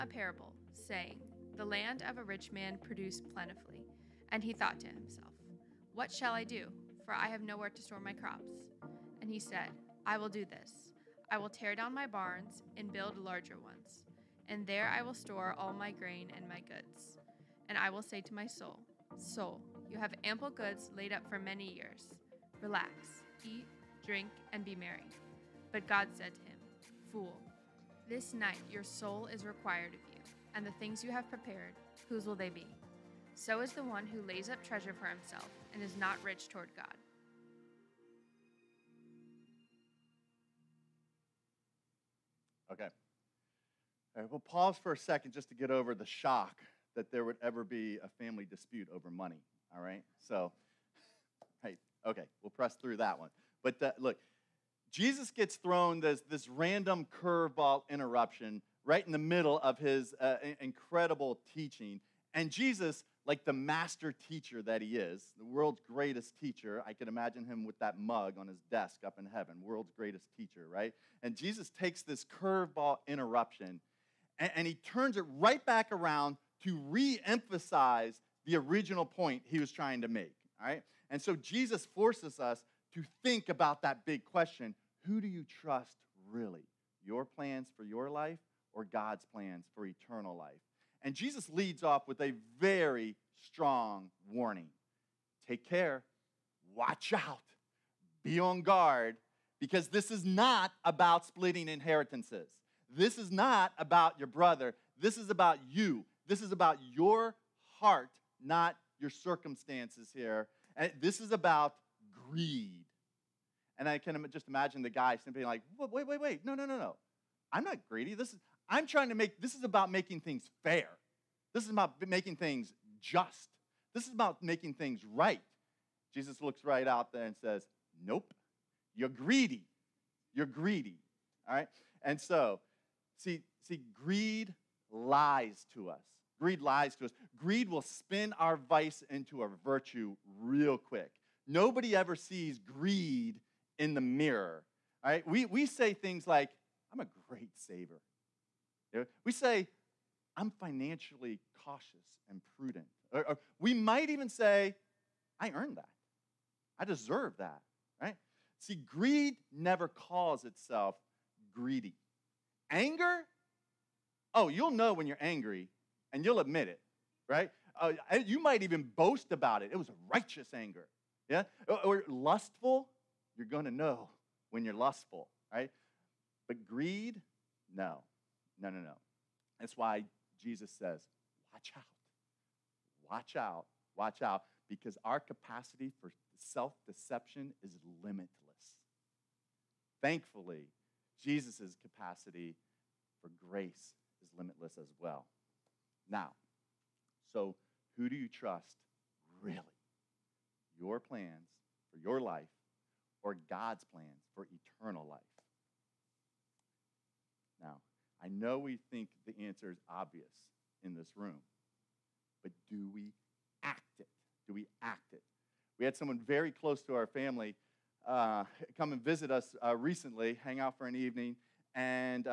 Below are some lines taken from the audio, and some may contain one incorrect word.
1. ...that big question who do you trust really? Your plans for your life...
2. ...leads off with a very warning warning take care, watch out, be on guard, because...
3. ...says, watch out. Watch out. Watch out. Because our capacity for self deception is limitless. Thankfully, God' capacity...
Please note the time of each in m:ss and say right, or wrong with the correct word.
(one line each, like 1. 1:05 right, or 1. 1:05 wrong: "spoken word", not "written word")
1. 1:23 right
2. 1:31 wrong: "strong", not "warning"
3. 3:00 wrong: "Jesus", not "God".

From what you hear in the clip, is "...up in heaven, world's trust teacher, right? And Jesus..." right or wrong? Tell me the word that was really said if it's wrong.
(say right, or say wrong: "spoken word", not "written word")
wrong: "greatest", not "trust".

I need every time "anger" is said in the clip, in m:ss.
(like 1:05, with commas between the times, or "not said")
2:42, 2:50.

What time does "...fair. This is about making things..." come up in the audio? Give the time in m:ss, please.
2:00.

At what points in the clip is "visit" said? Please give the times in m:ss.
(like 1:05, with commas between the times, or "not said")
3:39.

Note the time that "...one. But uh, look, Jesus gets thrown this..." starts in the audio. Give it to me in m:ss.
0:53.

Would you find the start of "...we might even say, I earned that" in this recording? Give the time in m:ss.
2:33.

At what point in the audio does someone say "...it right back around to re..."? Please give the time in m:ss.
1:15.